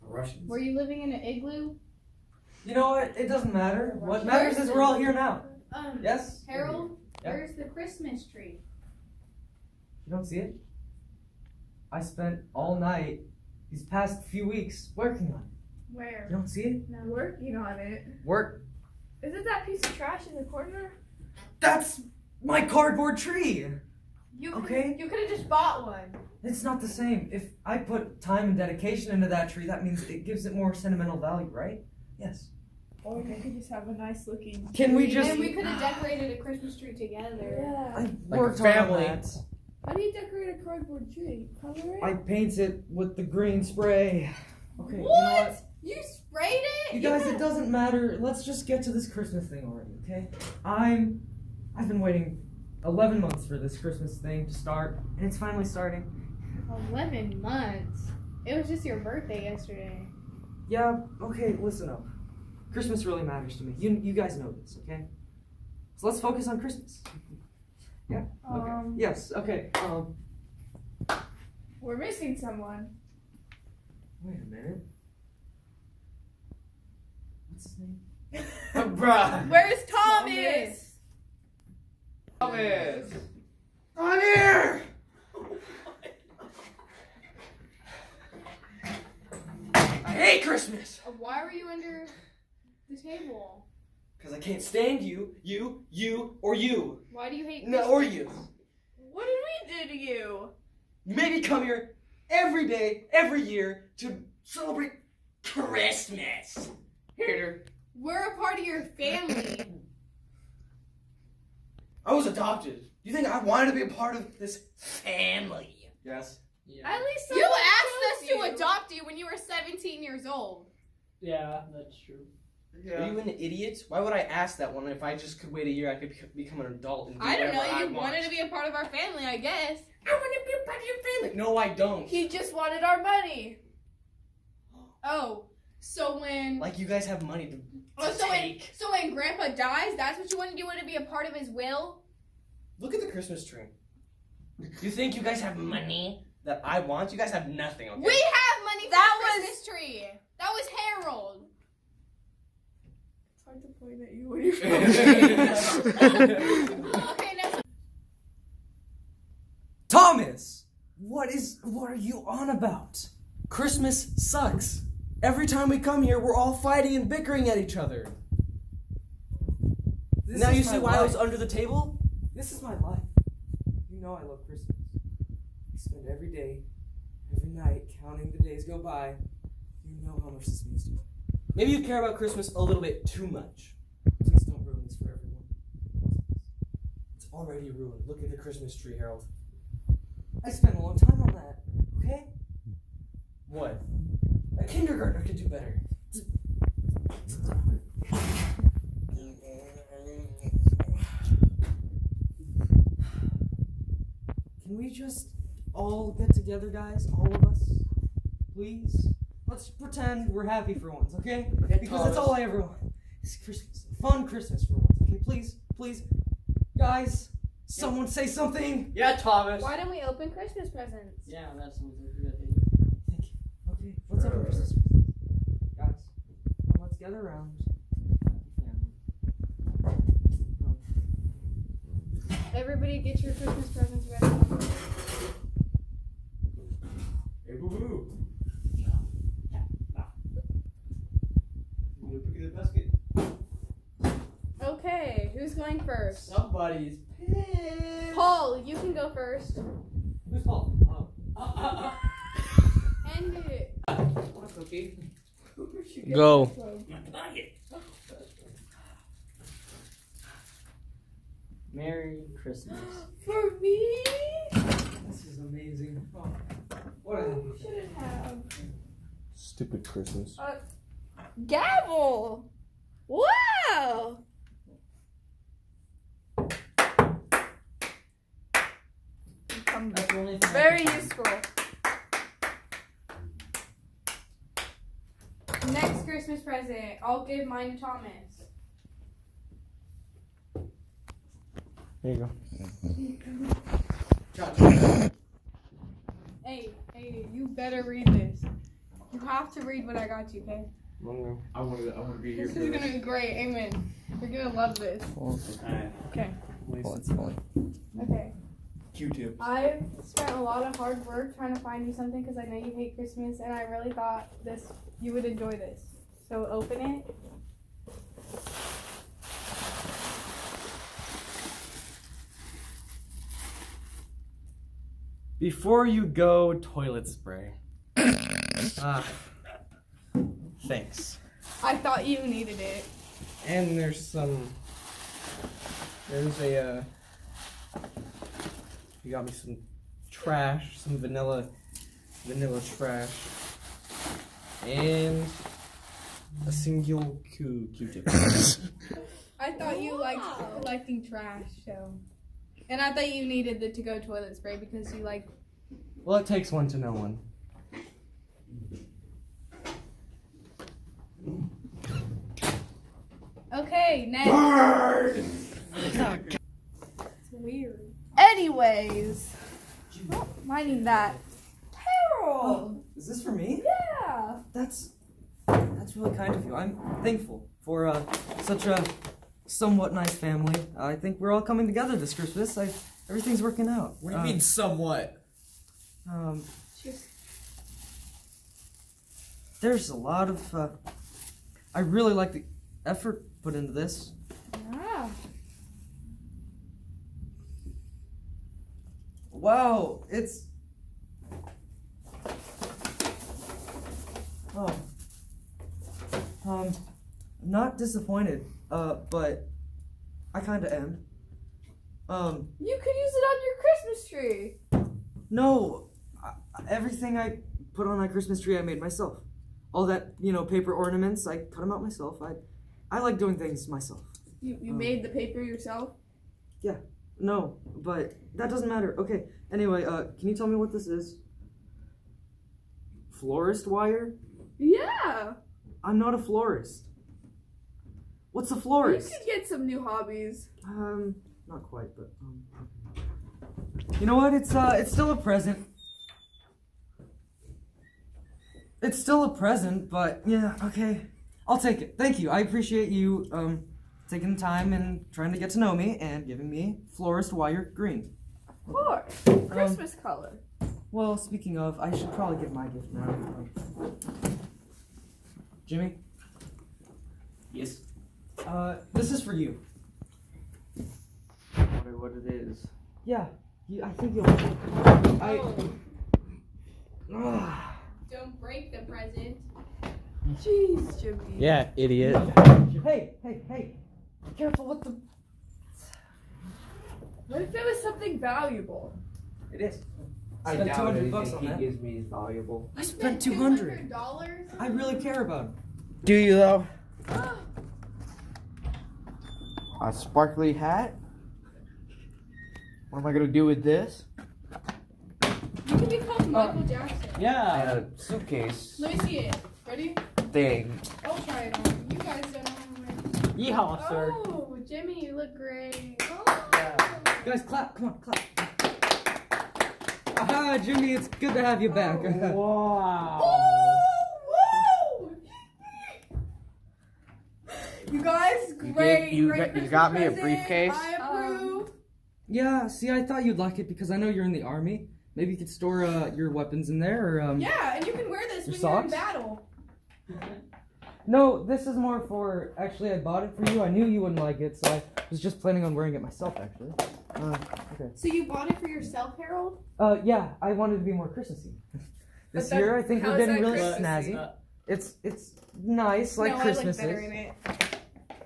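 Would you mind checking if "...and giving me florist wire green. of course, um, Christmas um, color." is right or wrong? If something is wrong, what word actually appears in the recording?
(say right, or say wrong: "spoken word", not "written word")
right.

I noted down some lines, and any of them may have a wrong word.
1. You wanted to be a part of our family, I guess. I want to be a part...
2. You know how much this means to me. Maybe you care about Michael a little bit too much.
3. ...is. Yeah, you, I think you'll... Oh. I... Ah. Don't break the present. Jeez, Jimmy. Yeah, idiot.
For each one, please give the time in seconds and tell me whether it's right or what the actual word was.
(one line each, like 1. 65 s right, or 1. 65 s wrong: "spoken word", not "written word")
1. 127 s right
2. 179 s wrong: "Christmas", not "Michael"
3. 472 s right.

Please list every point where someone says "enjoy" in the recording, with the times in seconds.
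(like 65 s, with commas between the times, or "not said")
315 s.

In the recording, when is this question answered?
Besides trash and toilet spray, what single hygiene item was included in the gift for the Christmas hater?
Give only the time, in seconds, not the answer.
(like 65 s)
347 s.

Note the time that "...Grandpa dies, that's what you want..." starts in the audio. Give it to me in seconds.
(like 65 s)
139 s.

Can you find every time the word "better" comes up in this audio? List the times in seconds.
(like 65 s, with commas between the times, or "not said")
195 s, 297 s, 556 s.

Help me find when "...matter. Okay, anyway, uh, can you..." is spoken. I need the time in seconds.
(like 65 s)
428 s.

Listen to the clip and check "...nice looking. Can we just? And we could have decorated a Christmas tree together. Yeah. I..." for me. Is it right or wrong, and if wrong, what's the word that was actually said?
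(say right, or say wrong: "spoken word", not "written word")
right.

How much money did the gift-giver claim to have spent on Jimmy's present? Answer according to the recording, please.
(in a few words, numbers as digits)
$200.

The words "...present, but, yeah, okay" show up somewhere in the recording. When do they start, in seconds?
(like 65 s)
449 s.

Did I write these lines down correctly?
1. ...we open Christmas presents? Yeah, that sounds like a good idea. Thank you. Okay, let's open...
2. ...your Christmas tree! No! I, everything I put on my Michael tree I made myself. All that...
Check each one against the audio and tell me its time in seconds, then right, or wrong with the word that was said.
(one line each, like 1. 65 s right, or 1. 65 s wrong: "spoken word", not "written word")
1. 219 s right
2. 413 s wrong: "Christmas", not "Michael".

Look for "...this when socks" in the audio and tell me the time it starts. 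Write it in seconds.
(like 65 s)
538 s.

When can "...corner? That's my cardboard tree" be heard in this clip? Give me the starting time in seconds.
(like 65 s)
20 s.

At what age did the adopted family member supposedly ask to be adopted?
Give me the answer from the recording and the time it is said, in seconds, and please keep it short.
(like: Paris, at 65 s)
17, at 119 s.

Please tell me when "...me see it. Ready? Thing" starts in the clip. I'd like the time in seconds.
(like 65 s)
508 s.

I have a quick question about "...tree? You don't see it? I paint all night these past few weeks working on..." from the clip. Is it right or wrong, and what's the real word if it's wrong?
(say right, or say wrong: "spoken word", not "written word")
wrong: "spent", not "paint".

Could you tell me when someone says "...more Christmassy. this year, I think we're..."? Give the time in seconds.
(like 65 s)
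550 s.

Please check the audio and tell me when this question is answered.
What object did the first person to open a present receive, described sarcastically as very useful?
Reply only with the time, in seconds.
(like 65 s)
271 s.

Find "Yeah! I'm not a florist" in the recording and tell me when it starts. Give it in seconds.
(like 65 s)
434 s.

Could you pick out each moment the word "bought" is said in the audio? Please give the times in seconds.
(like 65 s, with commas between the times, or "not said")
25 s, 542 s, 548 s.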